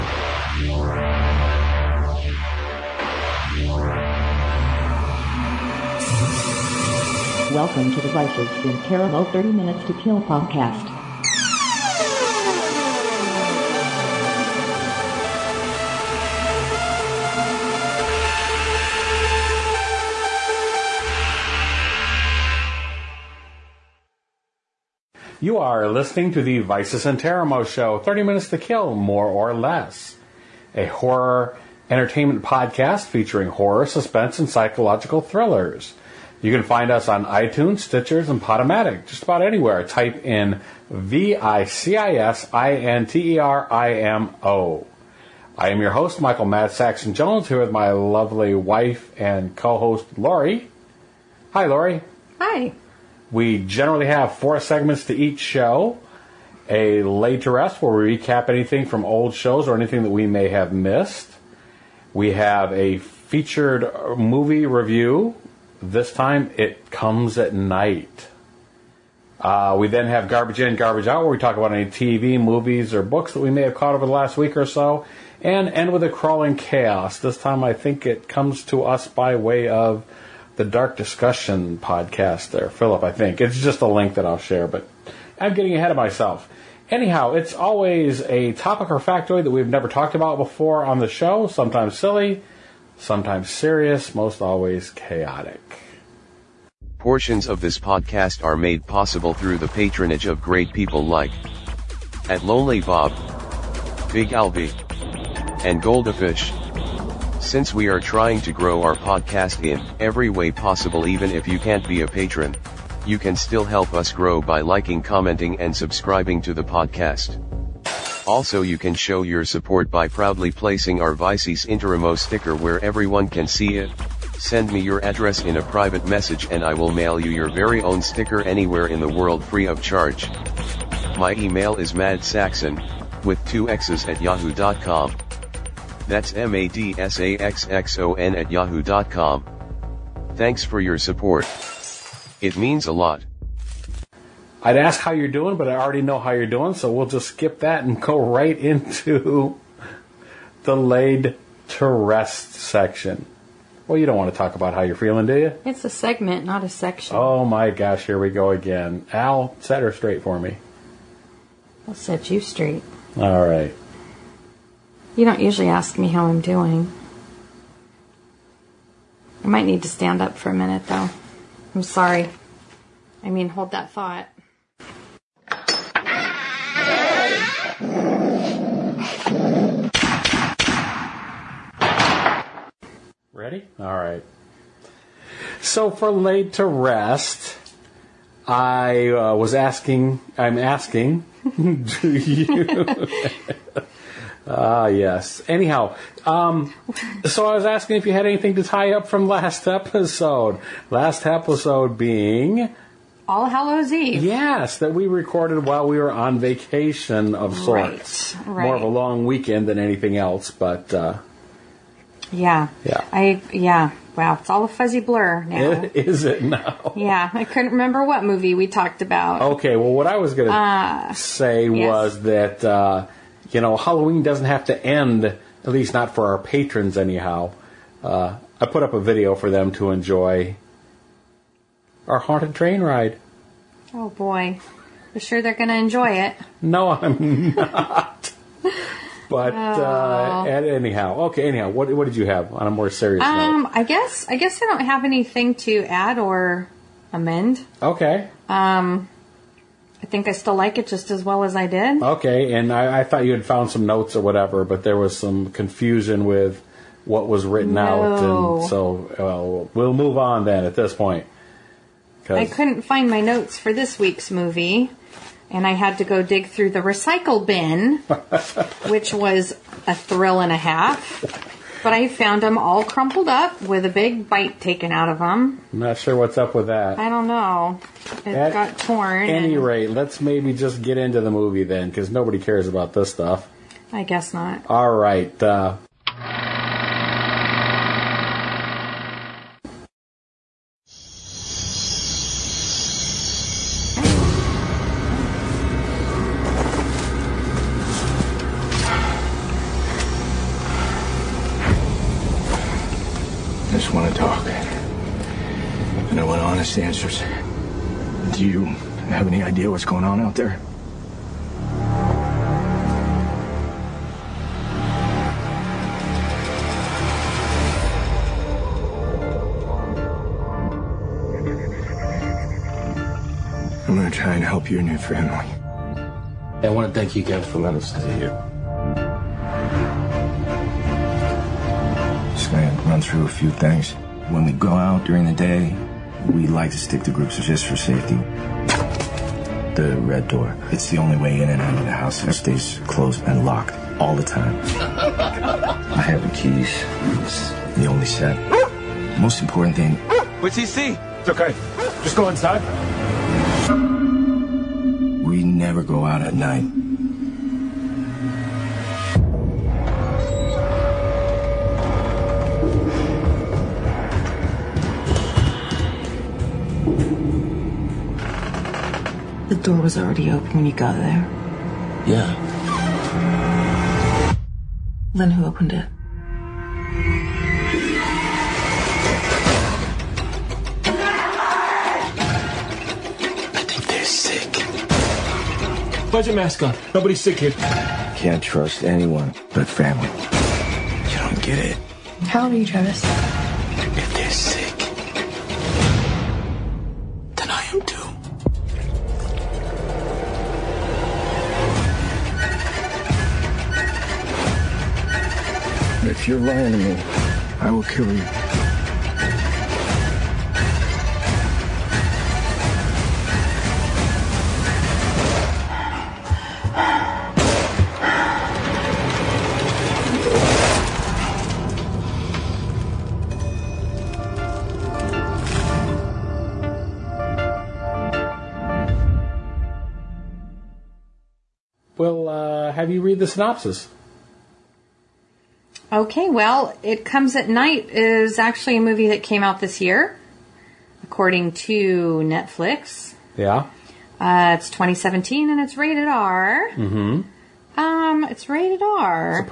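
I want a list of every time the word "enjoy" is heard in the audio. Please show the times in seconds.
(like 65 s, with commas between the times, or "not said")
229 s, 235 s.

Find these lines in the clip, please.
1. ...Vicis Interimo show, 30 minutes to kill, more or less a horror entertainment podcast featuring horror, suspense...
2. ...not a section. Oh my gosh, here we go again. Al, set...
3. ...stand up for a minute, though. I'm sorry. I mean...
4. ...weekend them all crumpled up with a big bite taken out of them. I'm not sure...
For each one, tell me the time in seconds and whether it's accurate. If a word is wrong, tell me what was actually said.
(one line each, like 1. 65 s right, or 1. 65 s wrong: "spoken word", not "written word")
1. 26 s right
2. 156 s right
3. 169 s right
4. 272 s wrong: "found", not "weekend".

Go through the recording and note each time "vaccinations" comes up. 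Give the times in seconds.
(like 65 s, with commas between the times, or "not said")
not said.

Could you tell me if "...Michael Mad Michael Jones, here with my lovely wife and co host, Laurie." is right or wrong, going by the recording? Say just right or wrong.
wrong.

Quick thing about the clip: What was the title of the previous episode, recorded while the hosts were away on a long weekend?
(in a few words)
All Hallows Eve.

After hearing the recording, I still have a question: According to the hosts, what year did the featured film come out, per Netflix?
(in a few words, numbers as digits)
2017.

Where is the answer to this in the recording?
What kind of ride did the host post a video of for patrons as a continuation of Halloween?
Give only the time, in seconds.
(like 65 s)
232 s.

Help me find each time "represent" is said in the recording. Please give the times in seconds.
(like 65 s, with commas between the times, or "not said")
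not said.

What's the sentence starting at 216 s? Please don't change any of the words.
Yeah, I couldn't remember what movie we talked about.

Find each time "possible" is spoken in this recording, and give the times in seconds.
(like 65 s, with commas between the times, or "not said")
98 s, 110 s.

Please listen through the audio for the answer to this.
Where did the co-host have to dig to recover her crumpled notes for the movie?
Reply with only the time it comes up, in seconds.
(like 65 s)
266 s.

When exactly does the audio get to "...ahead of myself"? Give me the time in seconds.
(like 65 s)
85 s.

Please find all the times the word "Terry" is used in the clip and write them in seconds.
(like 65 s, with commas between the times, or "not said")
not said.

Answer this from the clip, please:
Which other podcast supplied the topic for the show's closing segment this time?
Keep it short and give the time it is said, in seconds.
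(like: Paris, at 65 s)
Dark Discussion, at 80 s.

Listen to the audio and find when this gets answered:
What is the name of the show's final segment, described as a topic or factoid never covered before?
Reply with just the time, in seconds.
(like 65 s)
76 s.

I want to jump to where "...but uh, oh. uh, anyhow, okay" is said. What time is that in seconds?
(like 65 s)
239 s.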